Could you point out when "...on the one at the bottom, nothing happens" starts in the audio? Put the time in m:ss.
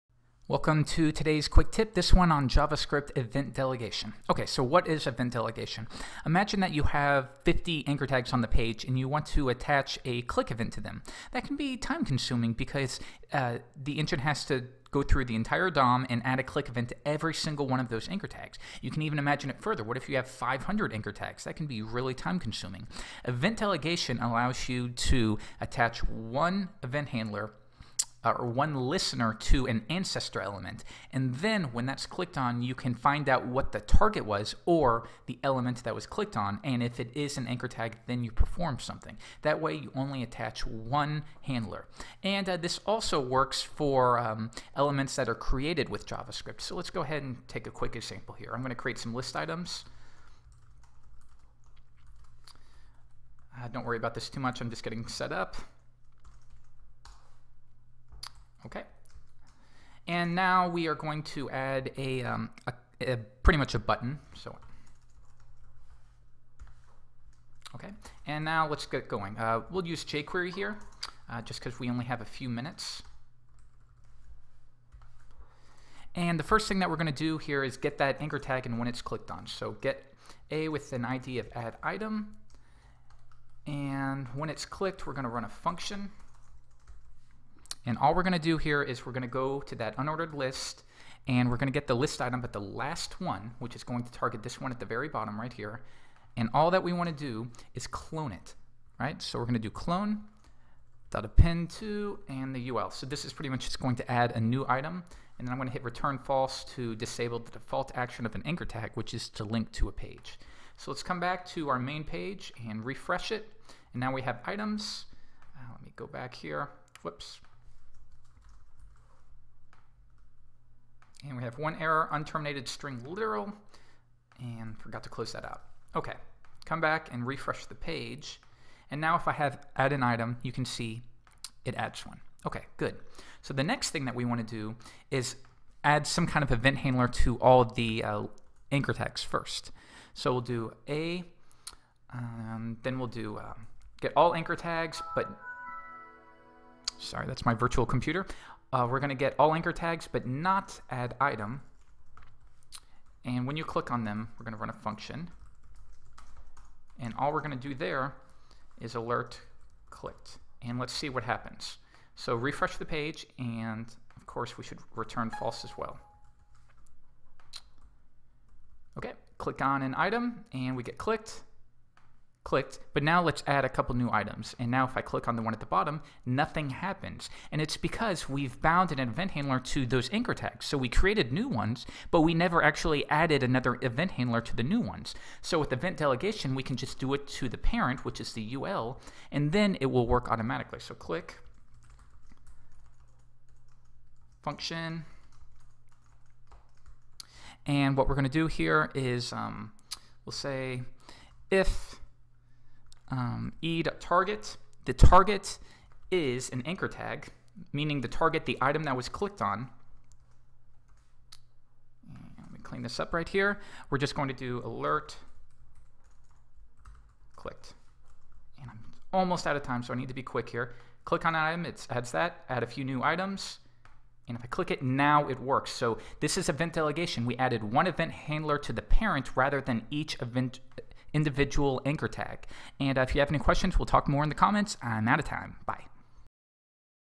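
2:55.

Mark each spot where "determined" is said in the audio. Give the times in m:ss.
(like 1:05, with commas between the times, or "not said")
not said.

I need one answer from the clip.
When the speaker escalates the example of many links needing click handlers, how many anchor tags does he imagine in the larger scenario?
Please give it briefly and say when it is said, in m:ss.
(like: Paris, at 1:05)
500, at 0:20.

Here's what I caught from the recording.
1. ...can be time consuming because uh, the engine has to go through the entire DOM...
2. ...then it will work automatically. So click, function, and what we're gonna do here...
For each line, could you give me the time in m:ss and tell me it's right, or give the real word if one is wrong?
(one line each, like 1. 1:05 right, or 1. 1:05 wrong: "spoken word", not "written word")
1. 0:11 right
2. 3:09 right.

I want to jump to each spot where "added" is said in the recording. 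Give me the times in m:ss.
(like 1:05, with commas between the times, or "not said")
3:03, 3:47.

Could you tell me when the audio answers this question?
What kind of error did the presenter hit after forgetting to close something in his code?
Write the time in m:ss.
2:02.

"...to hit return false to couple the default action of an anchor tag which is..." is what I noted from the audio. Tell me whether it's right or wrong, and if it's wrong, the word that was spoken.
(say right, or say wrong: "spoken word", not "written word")
wrong: "disable", not "couple".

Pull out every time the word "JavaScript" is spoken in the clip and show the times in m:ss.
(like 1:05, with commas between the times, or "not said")
0:02, 0:46.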